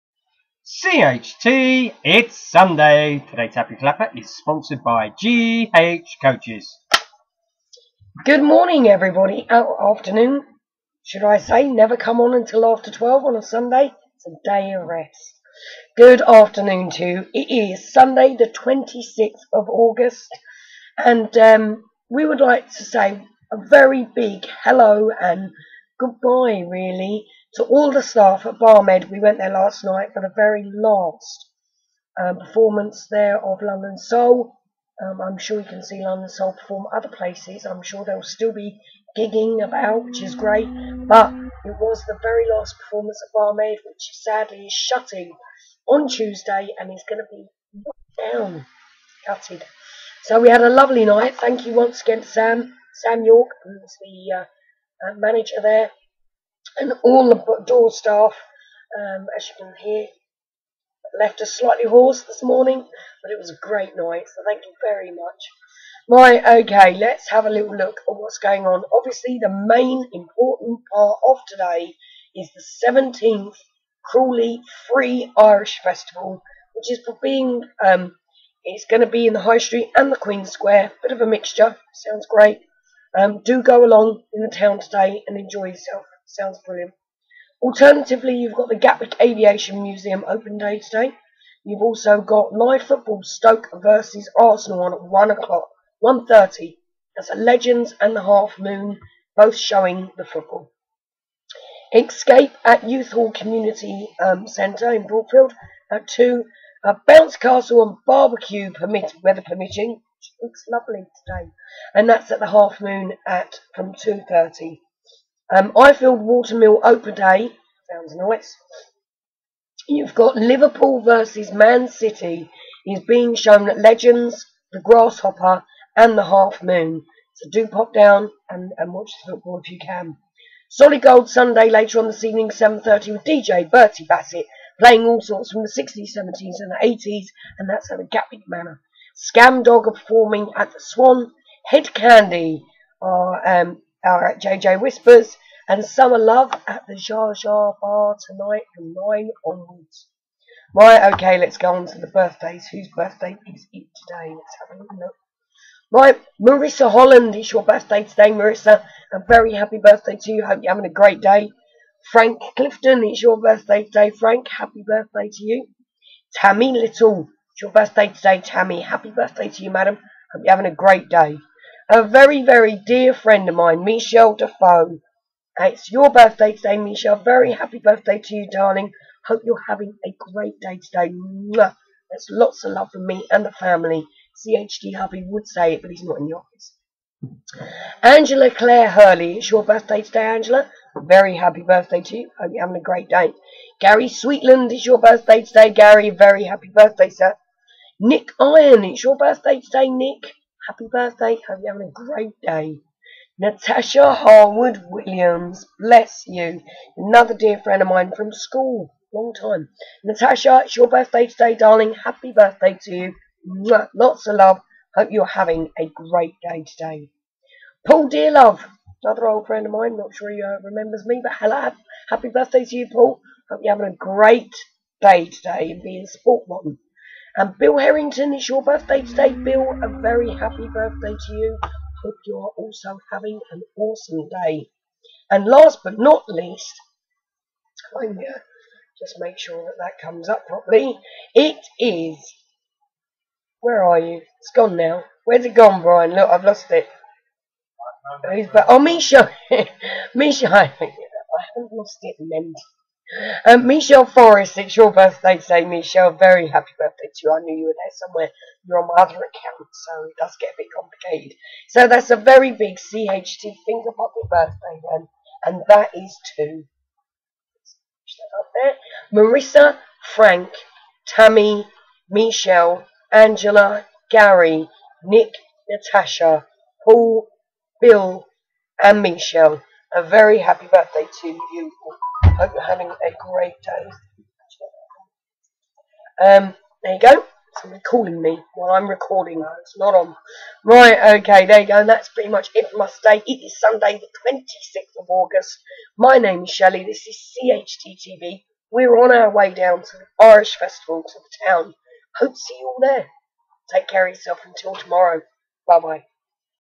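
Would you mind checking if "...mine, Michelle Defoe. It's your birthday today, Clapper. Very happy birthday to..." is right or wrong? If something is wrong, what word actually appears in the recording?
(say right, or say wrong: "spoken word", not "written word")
wrong: "Michelle", not "Clapper".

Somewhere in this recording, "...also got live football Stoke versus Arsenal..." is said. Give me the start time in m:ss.
1:31.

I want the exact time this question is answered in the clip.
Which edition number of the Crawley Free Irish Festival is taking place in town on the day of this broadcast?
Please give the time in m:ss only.
1:12.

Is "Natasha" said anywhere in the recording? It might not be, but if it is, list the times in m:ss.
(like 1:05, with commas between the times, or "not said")
3:23, 3:30, 4:35.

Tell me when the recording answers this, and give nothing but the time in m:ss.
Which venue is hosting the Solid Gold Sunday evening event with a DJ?
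2:18.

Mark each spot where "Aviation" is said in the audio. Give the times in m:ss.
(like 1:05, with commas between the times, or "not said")
1:29.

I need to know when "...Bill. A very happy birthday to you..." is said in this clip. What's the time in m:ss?
3:49.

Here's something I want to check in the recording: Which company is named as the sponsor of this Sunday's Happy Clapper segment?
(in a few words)
GH Coaches.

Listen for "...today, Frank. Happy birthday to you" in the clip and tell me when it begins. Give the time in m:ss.
2:43.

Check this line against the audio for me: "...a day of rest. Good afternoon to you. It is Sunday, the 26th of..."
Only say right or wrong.
right.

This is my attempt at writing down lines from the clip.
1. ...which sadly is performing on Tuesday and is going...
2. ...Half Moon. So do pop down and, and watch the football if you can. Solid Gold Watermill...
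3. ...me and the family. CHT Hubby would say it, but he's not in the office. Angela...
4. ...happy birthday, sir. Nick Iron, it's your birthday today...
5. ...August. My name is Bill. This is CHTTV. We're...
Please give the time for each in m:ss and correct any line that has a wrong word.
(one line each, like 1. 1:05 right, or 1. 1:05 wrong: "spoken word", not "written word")
1. 0:43 wrong: "shutting", not "performing"
2. 2:06 wrong: "Sunday", not "Watermill"
3. 3:03 right
4. 3:16 right
5. 4:55 wrong: "Shelley", not "Bill".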